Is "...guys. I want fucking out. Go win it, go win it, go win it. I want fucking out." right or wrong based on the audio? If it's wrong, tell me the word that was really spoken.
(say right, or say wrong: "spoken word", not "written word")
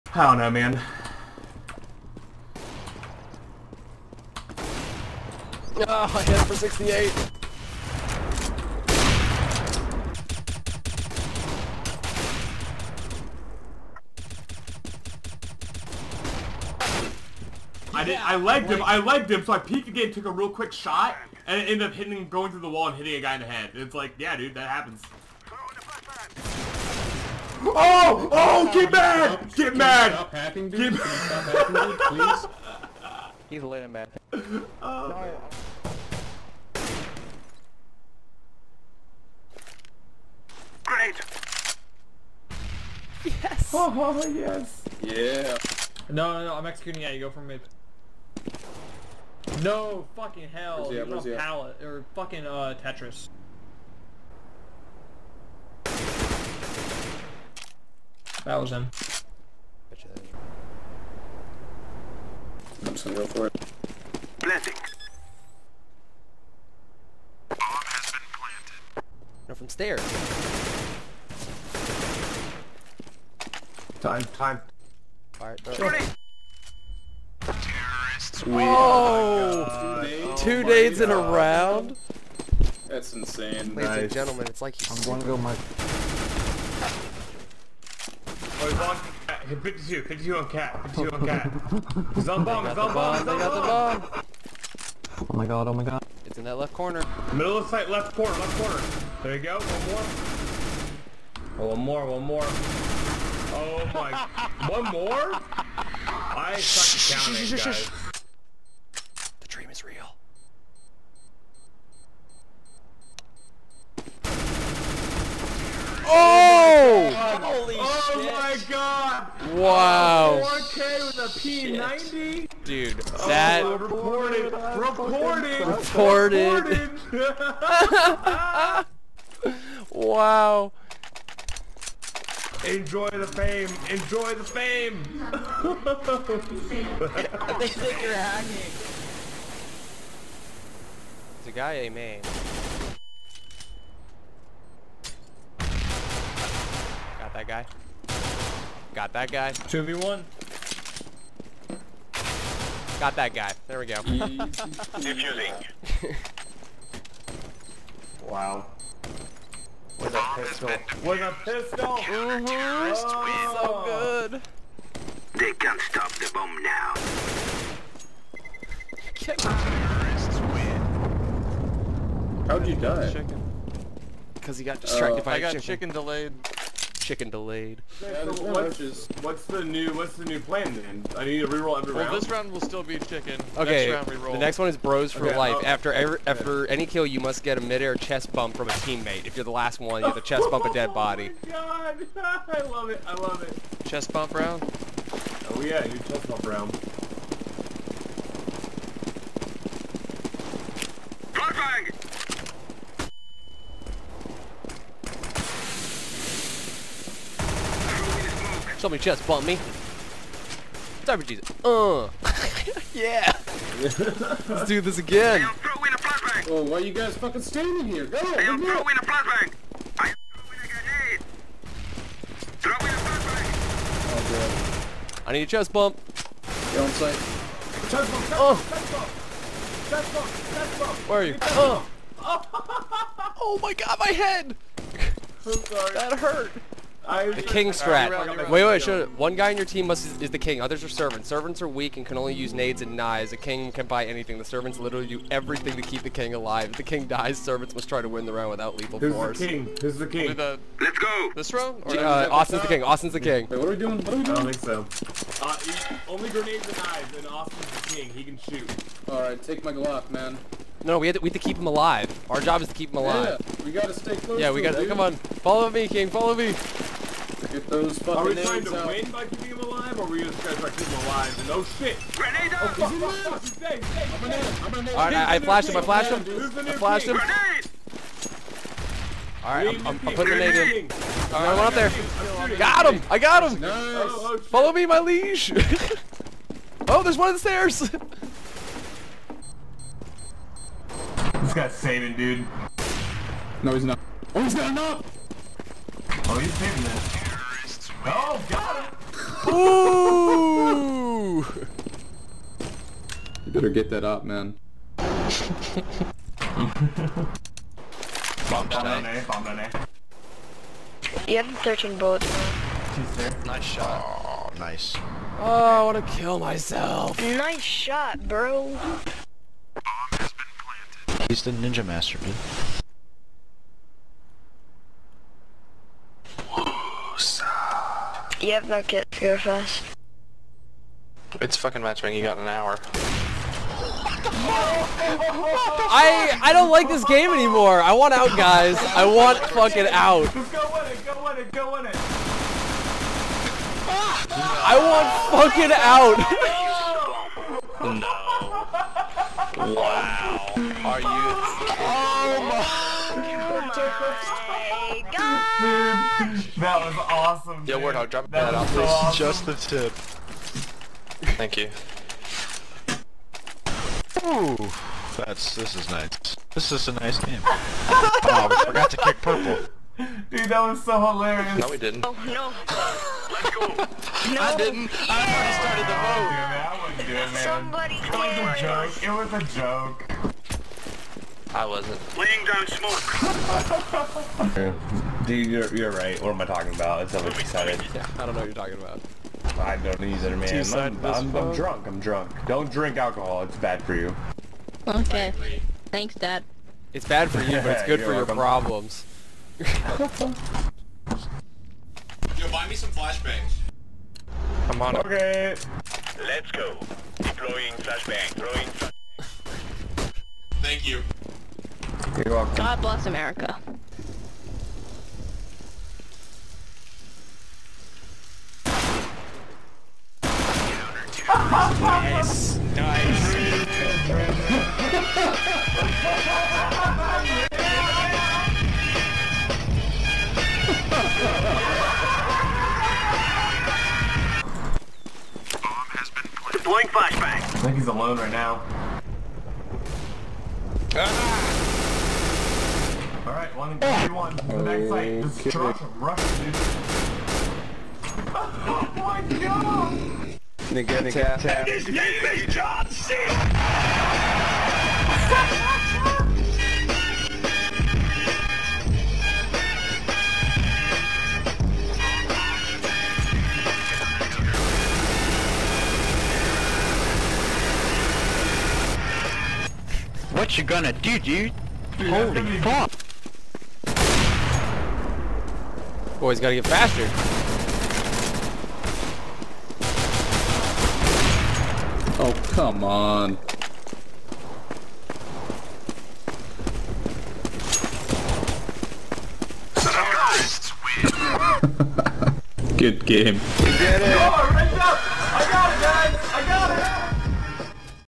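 right.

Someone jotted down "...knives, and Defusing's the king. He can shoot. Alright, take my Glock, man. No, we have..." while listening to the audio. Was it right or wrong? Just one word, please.
wrong.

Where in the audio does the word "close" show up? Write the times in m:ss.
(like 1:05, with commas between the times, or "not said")
4:24.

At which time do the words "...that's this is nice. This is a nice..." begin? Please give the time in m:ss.
6:05.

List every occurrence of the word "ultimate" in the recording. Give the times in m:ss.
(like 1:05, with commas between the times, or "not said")
not said.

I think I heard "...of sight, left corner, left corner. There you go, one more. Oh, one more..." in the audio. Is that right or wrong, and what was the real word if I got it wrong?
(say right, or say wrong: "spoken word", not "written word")
right.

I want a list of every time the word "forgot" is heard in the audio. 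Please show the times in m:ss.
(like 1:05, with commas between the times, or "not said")
6:08.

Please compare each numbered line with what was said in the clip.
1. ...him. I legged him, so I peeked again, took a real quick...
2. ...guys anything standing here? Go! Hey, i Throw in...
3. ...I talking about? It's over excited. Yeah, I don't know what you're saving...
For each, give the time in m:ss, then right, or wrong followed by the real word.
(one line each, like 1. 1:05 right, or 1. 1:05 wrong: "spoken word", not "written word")
1. 0:18 right
2. 3:36 wrong: "fucking", not "anything"
3. 6:26 wrong: "talking", not "saving".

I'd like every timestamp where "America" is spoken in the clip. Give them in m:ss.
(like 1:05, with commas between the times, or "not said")
6:53.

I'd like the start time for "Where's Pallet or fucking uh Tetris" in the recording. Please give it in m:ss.
0:51.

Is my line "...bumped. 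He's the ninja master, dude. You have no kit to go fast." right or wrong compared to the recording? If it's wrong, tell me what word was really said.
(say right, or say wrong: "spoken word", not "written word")
wrong: "planted", not "bumped".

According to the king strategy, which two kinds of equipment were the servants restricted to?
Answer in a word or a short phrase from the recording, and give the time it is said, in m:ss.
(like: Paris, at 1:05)
Nades and knives, at 4:02.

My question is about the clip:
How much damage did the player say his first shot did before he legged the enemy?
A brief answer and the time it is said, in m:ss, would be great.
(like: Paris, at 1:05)
68, at 0:06.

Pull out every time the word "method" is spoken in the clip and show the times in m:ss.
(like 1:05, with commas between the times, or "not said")
not said.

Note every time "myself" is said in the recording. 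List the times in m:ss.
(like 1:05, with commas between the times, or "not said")
5:16.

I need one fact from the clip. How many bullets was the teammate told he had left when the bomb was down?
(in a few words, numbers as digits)
13.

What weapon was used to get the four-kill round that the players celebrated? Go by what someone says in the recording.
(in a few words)
P90.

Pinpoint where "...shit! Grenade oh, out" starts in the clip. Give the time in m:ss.
4:31.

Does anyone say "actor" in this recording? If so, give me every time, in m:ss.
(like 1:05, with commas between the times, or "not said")
not said.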